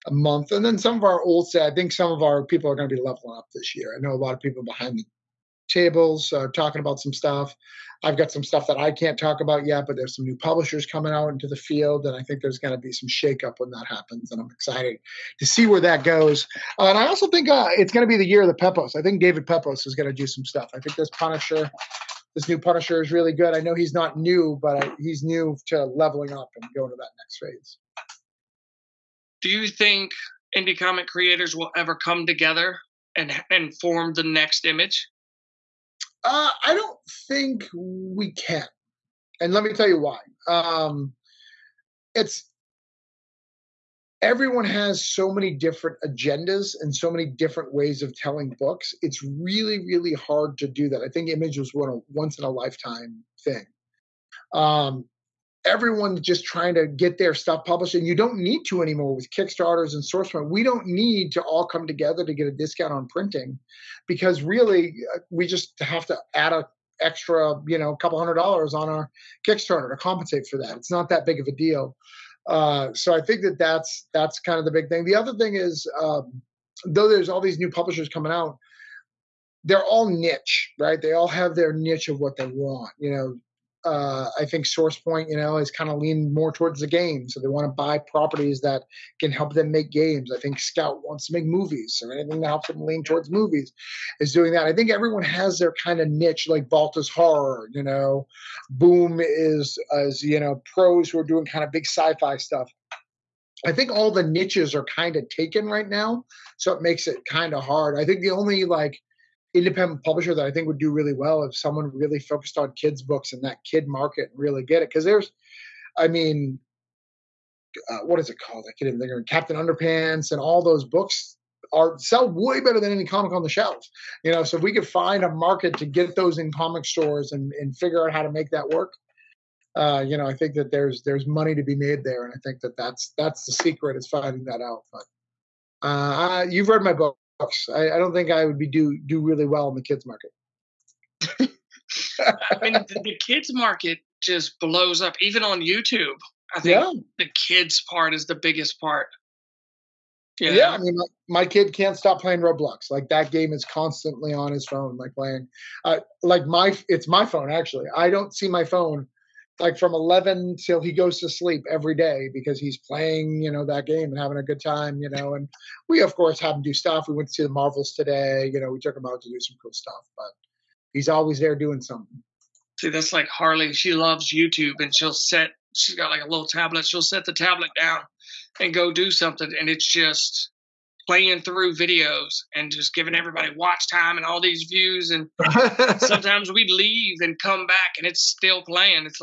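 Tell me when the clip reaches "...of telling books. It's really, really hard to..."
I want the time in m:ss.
0:48.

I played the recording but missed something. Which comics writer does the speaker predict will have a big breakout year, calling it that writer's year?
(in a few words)
David Pepose.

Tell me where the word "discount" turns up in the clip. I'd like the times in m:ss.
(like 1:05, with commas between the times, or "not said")
1:02.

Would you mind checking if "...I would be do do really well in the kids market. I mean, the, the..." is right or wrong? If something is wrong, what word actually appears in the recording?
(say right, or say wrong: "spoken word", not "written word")
right.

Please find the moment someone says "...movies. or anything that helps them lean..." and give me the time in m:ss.
1:31.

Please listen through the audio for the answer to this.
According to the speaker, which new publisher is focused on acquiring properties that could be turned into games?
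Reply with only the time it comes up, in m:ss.
1:24.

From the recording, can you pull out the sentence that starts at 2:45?
And we, of course, have him do stuff.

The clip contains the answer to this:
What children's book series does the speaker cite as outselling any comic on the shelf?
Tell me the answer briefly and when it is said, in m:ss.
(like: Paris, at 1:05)
Captain Underpants, at 1:59.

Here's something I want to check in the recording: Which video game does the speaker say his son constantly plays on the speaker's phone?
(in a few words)
Roblox.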